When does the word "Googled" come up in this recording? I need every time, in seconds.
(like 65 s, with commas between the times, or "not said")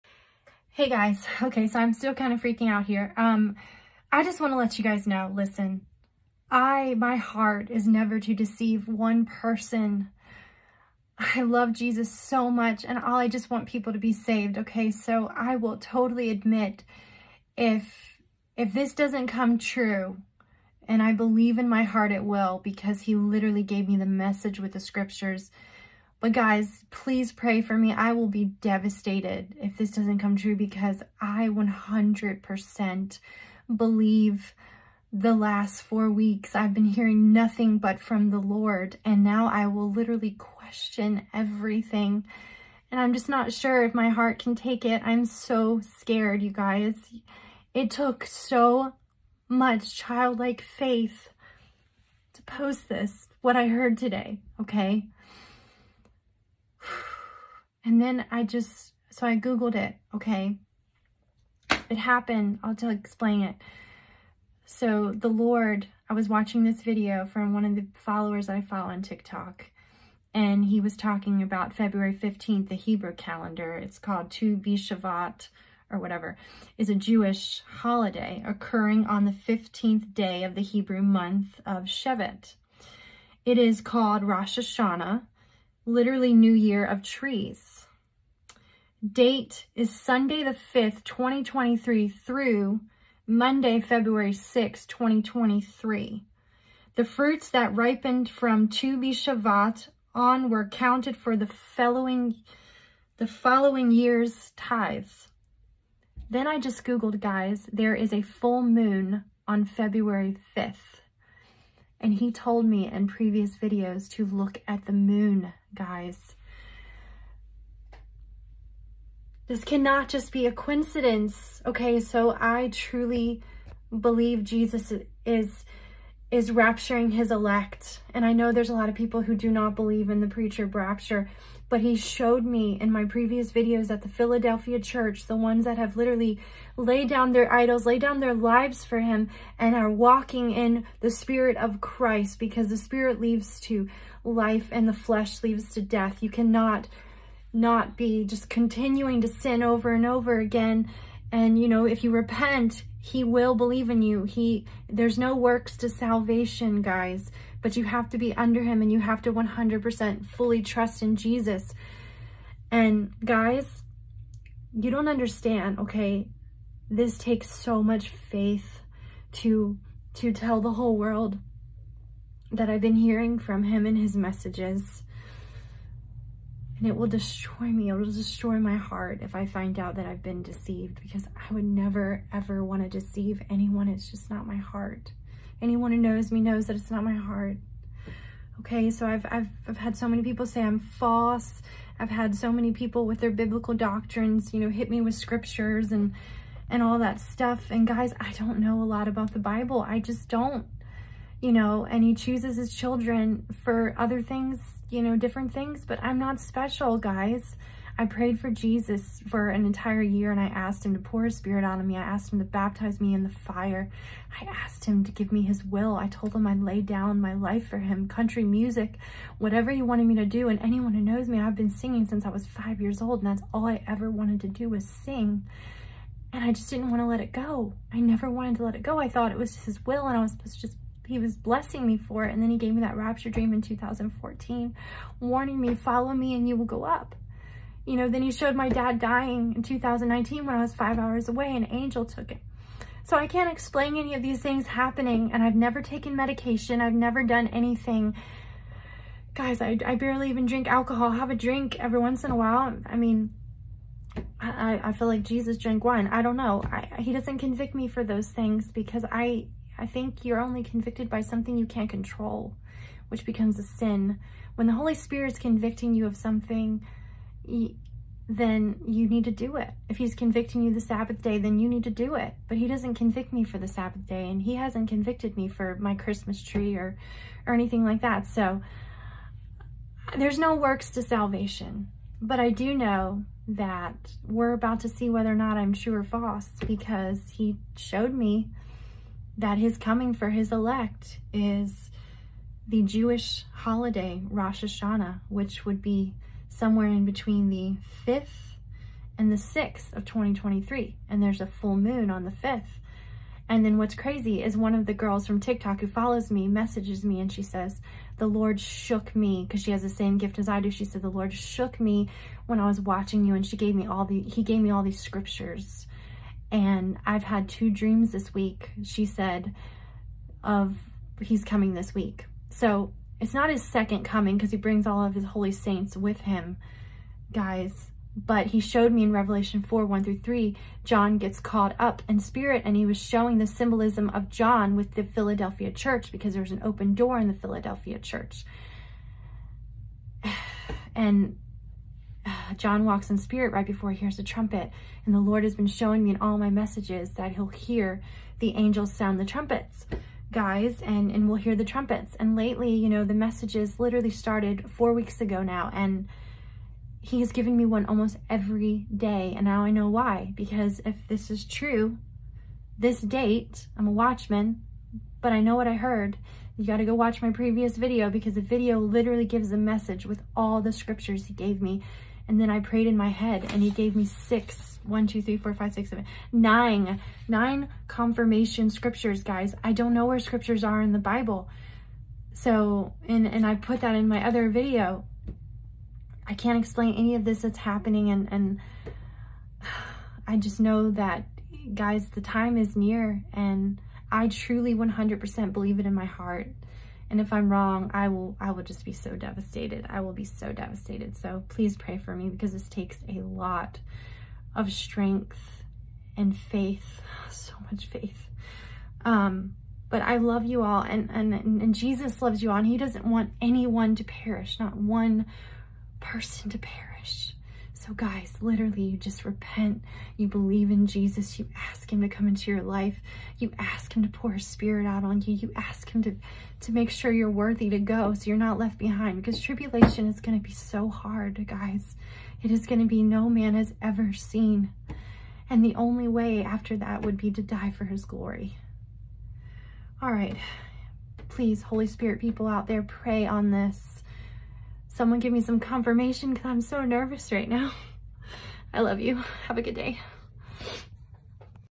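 59 s, 106 s.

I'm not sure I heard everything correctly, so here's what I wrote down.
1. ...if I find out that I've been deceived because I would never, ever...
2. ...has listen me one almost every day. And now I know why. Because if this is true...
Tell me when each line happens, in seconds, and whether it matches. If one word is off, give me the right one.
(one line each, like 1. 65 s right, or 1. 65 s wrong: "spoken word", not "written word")
1. 179 s right
2. 357 s wrong: "given", not "listen".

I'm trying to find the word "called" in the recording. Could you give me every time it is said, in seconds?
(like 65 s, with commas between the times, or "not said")
73 s, 83 s, 331 s.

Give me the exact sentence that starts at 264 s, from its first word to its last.
When the Holy Spirit's convicting you of something, then you need to do it.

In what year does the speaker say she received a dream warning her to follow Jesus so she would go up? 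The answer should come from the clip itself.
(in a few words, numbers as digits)
2014.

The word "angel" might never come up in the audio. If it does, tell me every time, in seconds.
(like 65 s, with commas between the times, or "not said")
241 s, 348 s.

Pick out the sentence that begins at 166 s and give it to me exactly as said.
This takes so much faith to, to tell the whole world that I've been hearing from him in his messages.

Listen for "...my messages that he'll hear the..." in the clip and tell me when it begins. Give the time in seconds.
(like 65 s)
346 s.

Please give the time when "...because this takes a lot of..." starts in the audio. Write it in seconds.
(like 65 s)
402 s.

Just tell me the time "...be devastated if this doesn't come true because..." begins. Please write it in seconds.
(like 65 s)
28 s.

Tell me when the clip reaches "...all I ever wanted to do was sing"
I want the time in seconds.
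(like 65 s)
223 s.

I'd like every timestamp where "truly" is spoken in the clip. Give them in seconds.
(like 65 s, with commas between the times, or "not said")
122 s, 394 s.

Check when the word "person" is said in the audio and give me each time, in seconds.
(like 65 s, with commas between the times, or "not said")
9 s, 415 s.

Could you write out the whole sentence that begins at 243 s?
So I can't explain any of these things happening and I've never taken medication.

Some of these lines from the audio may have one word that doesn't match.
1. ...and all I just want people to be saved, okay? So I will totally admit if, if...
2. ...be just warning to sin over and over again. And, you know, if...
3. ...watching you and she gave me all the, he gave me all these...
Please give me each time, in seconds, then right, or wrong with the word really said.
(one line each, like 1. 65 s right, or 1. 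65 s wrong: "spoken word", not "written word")
1. 12 s right
2. 147 s wrong: "continuing", not "warning"
3. 312 s right.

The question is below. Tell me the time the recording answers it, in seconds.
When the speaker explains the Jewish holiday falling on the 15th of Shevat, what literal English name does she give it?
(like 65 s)
86 s.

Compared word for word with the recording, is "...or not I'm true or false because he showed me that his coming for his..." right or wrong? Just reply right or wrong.
right.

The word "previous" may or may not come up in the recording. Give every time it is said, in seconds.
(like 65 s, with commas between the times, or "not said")
113 s, 133 s, 367 s.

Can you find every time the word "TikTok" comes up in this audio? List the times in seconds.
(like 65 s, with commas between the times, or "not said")
69 s, 305 s.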